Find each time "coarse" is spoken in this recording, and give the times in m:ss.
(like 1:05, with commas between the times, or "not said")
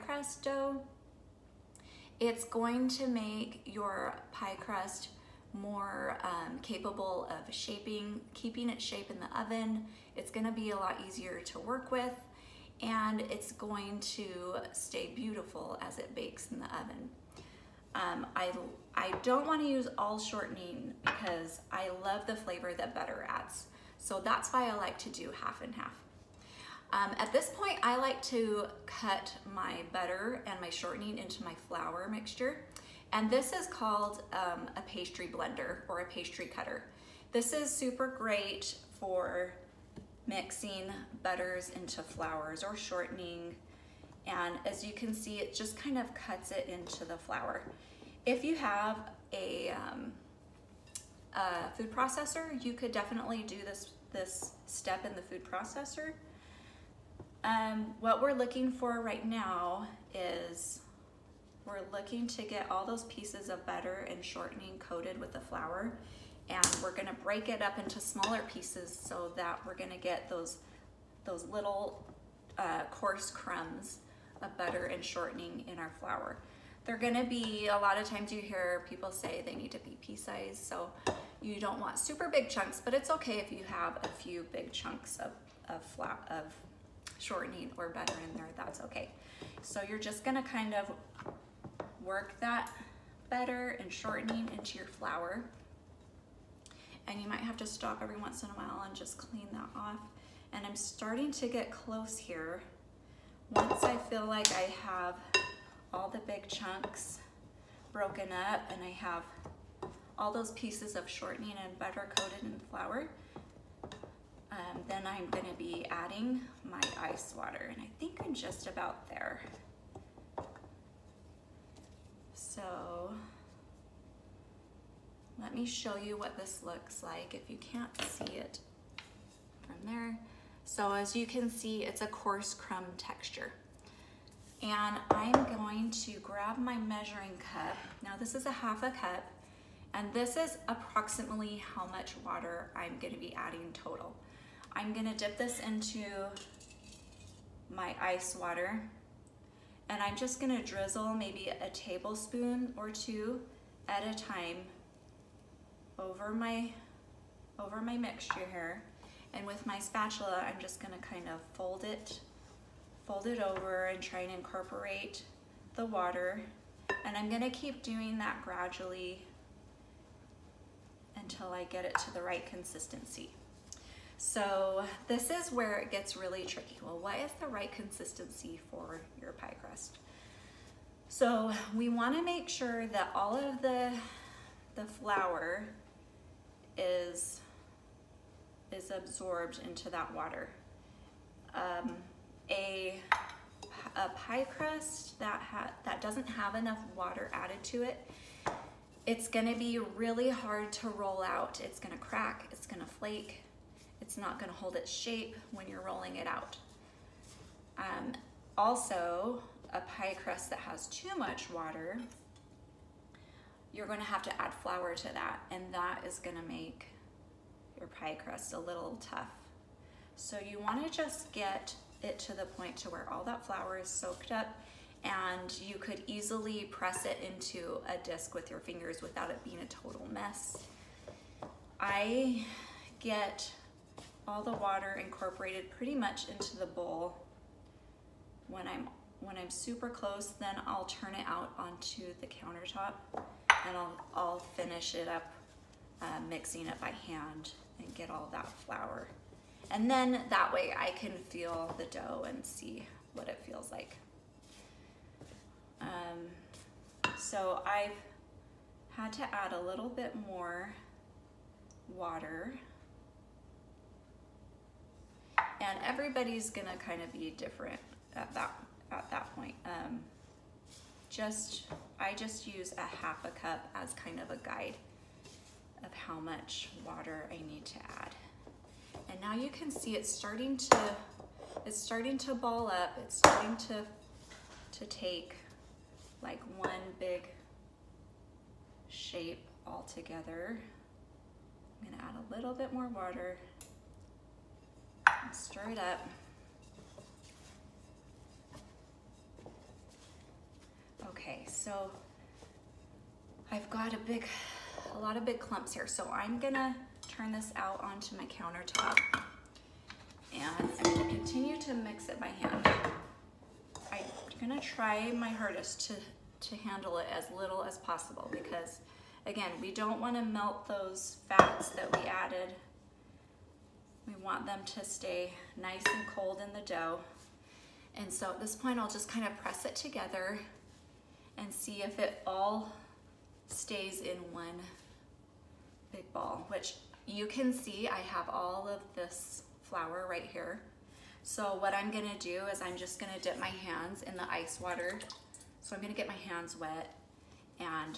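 1:12, 2:12.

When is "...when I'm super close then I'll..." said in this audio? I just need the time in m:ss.
3:59.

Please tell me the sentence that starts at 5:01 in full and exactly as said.
Okay, so I've got a big a lot of big clumps here.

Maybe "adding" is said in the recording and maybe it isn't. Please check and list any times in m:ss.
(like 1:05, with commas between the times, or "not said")
1:55, 2:23.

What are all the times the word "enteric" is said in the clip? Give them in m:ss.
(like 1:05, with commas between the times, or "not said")
not said.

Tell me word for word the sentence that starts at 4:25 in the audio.
And everybody's gonna kind of be different at that at that point.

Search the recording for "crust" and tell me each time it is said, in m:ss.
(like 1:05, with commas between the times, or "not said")
0:04, 2:59, 3:14, 3:30, 3:38.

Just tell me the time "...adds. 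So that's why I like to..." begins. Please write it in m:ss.
0:23.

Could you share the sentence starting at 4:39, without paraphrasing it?
And now you can see it's starting to, it's starting to ball up.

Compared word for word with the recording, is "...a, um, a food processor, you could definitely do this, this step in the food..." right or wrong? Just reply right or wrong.
right.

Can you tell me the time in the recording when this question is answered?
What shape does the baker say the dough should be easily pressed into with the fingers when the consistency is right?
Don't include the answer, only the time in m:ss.
3:47.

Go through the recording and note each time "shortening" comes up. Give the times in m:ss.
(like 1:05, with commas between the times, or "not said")
0:20, 0:30, 0:42, 1:04, 1:15, 1:27, 1:33, 1:51.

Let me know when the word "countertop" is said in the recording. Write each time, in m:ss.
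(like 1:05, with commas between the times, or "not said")
4:02, 5:08.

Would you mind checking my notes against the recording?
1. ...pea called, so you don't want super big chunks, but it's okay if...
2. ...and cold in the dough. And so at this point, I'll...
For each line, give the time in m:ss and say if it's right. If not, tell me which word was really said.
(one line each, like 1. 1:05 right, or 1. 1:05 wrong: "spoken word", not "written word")
1. 1:20 wrong: "sized", not "called"
2. 5:25 right.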